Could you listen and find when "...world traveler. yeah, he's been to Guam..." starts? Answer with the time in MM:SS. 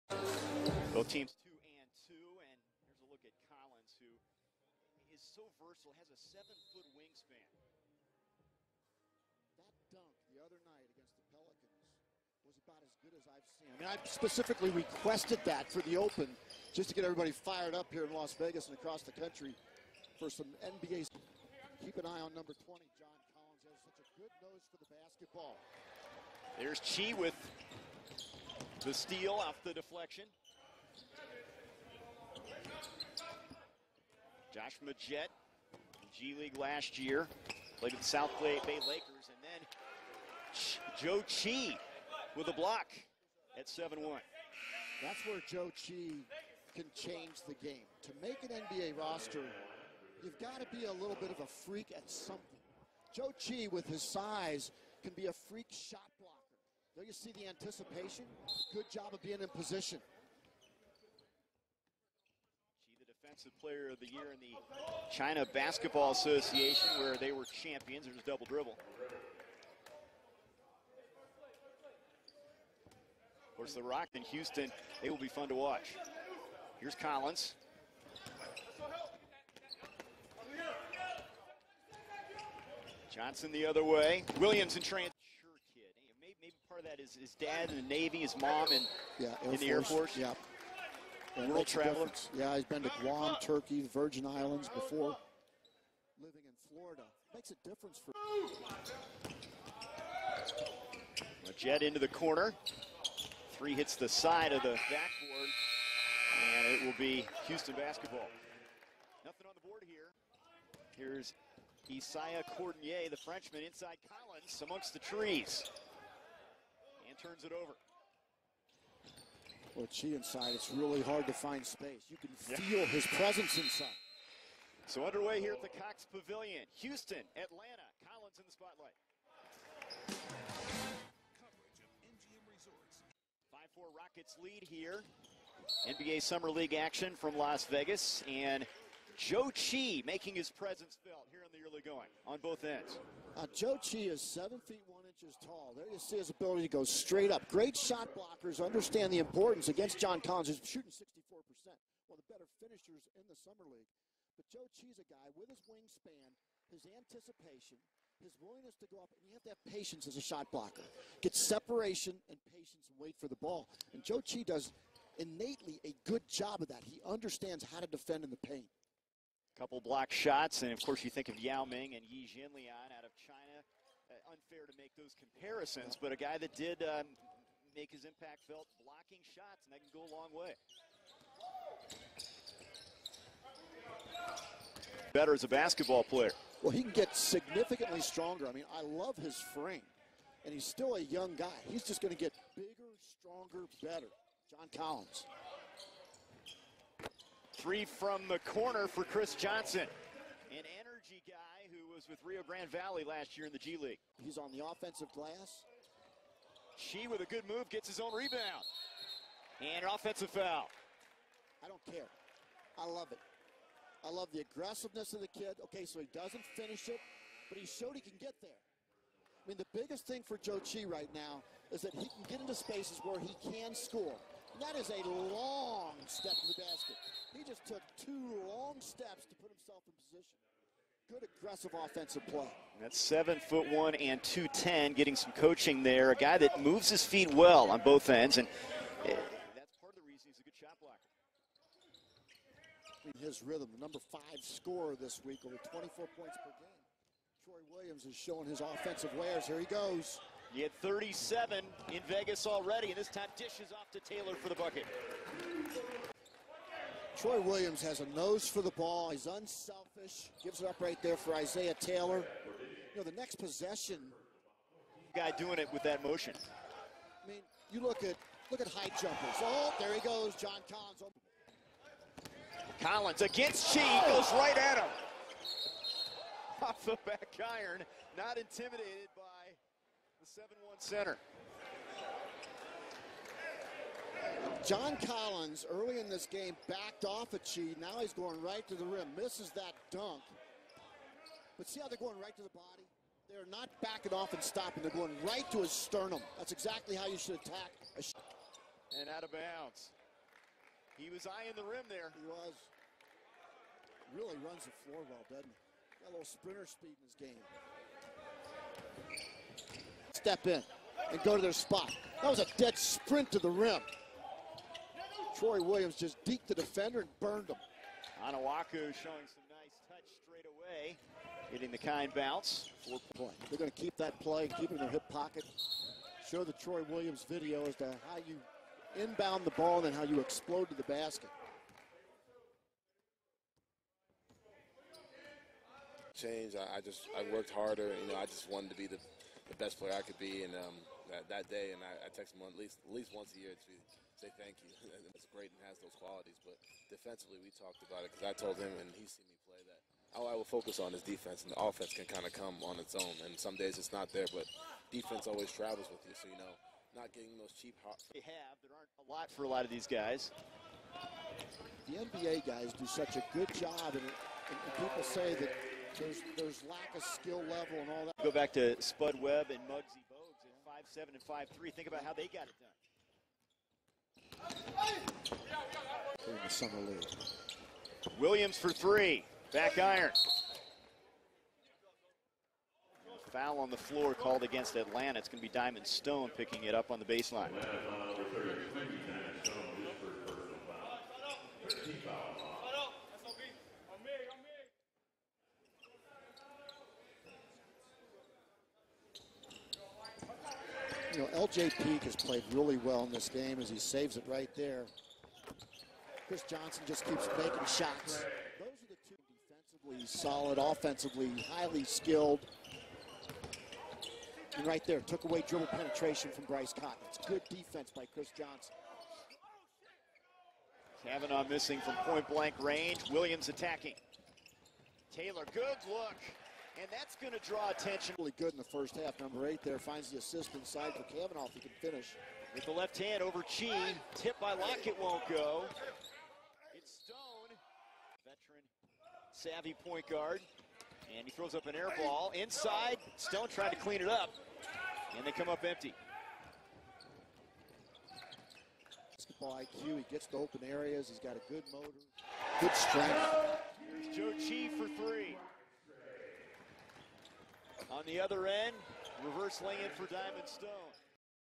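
01:31.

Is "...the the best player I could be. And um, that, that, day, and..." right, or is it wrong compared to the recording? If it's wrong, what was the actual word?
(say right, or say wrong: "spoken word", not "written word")
right.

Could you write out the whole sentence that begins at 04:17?
Troy Williams has a nose for the ball.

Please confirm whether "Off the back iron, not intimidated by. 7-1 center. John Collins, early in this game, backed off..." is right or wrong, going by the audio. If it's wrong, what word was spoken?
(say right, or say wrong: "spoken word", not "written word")
right.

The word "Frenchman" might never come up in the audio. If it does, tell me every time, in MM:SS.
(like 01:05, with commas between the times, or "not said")
01:53.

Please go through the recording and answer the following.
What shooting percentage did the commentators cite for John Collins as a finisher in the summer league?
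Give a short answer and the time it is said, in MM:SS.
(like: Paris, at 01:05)
64%, at 02:30.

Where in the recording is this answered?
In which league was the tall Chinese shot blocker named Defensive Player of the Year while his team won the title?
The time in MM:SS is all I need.
01:05.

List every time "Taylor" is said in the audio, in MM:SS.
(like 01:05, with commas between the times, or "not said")
04:14, 04:21, 07:05.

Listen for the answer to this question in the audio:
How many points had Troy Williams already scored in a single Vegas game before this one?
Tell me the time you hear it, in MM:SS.
04:10.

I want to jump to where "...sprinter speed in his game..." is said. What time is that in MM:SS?
05:06.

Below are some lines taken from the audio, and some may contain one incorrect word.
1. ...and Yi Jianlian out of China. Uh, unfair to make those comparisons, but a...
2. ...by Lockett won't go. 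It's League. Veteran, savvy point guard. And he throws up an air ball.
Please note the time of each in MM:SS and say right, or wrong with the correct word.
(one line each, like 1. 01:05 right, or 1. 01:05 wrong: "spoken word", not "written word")
1. 02:51 right
2. 07:14 wrong: "Stone", not "League".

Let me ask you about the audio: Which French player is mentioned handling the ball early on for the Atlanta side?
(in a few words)
Isaiah Cordinier.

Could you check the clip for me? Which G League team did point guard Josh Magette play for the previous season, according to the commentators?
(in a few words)
South Bay Lakers.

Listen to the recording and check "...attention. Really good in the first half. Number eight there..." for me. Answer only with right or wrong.
right.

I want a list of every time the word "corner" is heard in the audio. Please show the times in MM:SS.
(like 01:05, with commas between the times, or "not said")
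01:42, 03:18.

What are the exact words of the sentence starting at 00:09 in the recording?
That dunk the other night against the Pelicans was about as good as I've seen.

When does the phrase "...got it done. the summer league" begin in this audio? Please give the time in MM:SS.
06:12.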